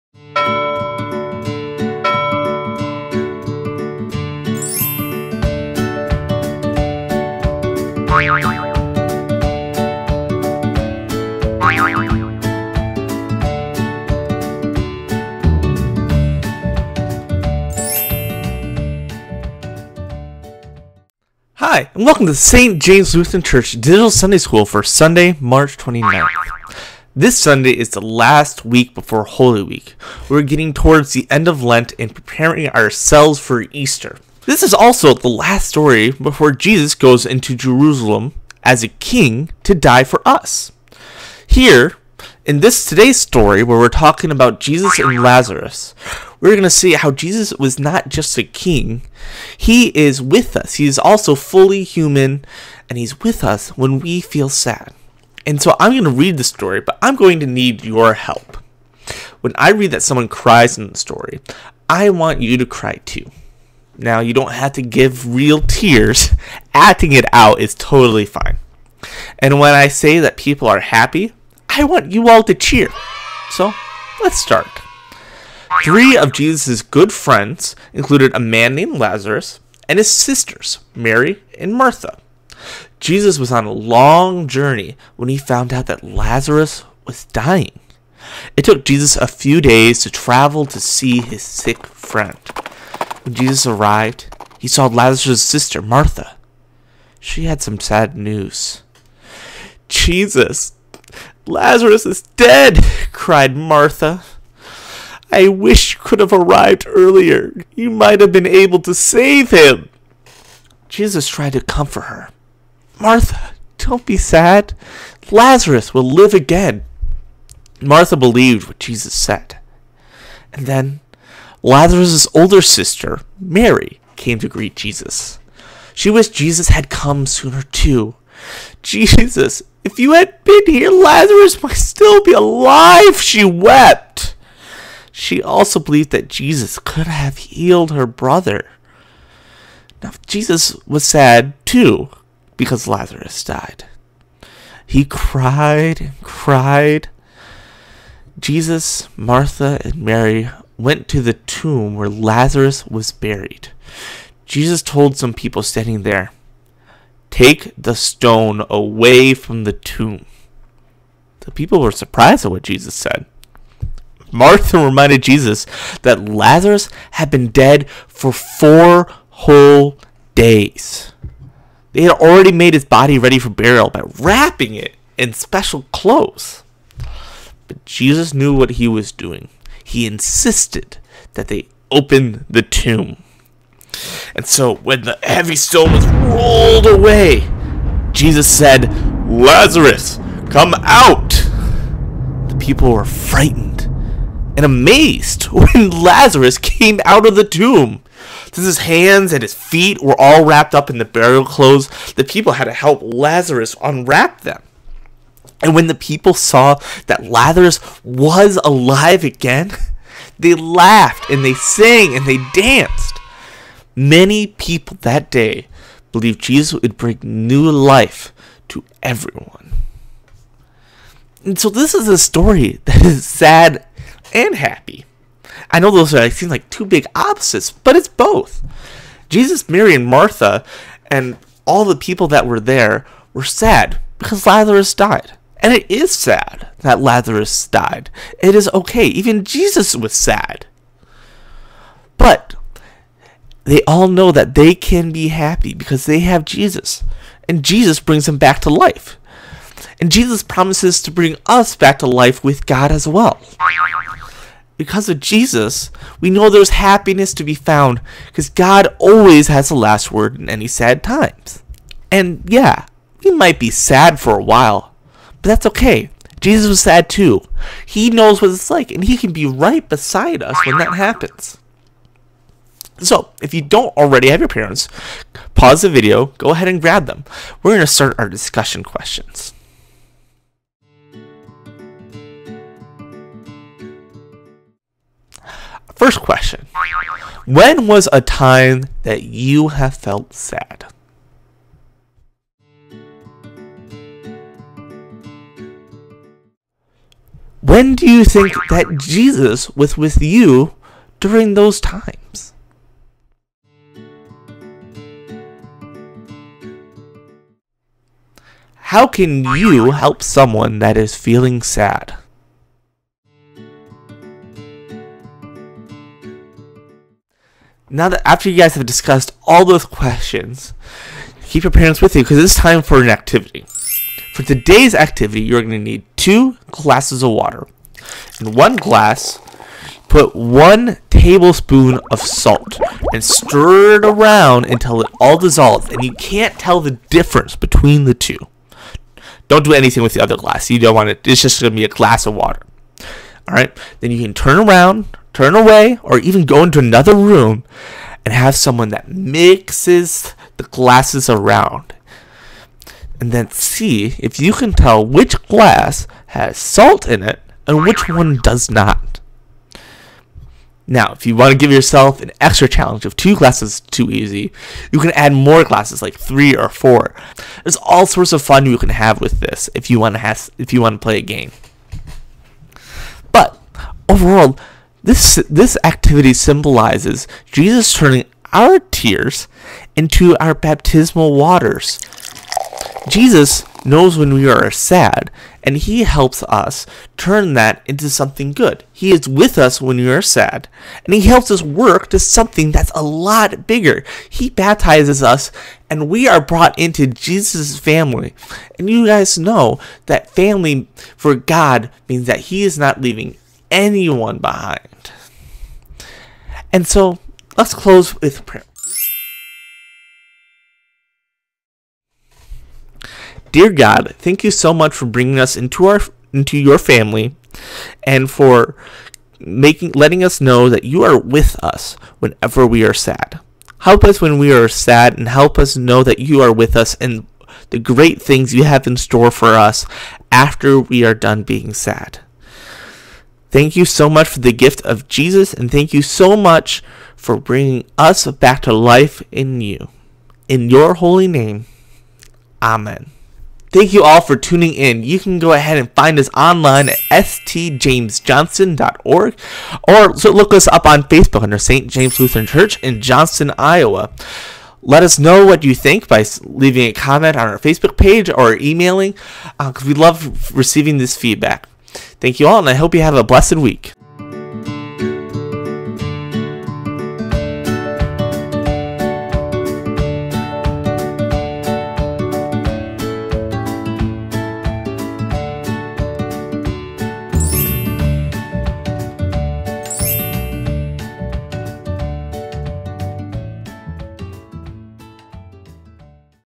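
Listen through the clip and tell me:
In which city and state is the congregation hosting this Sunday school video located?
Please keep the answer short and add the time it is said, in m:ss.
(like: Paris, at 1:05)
Johnston, Iowa, at 7:33.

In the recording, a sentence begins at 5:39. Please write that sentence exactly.
Don't do anything with the other glass.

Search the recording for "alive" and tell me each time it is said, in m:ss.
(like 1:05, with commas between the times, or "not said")
2:12, 3:28.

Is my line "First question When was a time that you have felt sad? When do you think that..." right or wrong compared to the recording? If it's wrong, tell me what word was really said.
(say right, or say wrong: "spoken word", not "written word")
right.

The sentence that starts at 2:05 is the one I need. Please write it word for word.
She wished Jesus had come sooner too.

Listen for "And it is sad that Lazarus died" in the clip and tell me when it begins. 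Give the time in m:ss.
3:55.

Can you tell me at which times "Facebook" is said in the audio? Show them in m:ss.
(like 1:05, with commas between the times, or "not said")
7:31, 7:37.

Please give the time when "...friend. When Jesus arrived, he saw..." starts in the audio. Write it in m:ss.
1:31.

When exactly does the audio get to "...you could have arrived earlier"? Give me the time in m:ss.
1:45.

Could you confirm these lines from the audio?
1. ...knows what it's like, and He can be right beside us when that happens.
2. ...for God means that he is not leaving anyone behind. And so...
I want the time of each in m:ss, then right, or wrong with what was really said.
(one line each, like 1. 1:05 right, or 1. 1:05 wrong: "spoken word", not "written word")
1. 4:28 right
2. 6:41 right.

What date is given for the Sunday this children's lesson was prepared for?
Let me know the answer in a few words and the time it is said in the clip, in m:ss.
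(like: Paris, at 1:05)
March 29, at 0:25.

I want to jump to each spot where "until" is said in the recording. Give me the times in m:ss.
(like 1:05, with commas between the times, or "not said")
5:34.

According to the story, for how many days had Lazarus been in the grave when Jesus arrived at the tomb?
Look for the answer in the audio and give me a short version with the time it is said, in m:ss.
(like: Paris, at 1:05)
4, at 2:48.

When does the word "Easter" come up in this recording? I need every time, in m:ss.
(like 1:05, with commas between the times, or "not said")
0:33.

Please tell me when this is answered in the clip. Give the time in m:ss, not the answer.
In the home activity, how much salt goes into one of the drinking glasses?
5:30.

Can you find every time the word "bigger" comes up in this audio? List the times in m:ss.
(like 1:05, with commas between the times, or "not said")
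6:33.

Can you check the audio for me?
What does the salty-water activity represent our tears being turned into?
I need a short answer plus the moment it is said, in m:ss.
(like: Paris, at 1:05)
Baptismal waters, at 6:20.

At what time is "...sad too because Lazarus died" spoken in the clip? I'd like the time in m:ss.
2:21.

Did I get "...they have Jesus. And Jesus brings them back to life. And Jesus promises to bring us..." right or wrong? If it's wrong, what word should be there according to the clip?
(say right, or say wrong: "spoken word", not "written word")
right.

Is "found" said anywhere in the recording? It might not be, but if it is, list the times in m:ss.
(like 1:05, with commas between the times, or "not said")
1:25, 4:17.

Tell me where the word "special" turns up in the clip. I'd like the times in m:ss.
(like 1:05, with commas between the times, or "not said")
2:55.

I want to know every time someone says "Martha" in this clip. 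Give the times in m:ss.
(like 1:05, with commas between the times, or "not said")
1:21, 1:35, 1:43, 1:52, 1:57, 2:29, 2:44, 3:50.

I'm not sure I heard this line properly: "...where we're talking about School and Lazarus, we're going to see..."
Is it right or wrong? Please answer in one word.
wrong.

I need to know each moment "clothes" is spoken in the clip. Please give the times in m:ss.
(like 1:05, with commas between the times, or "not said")
2:55, 3:21.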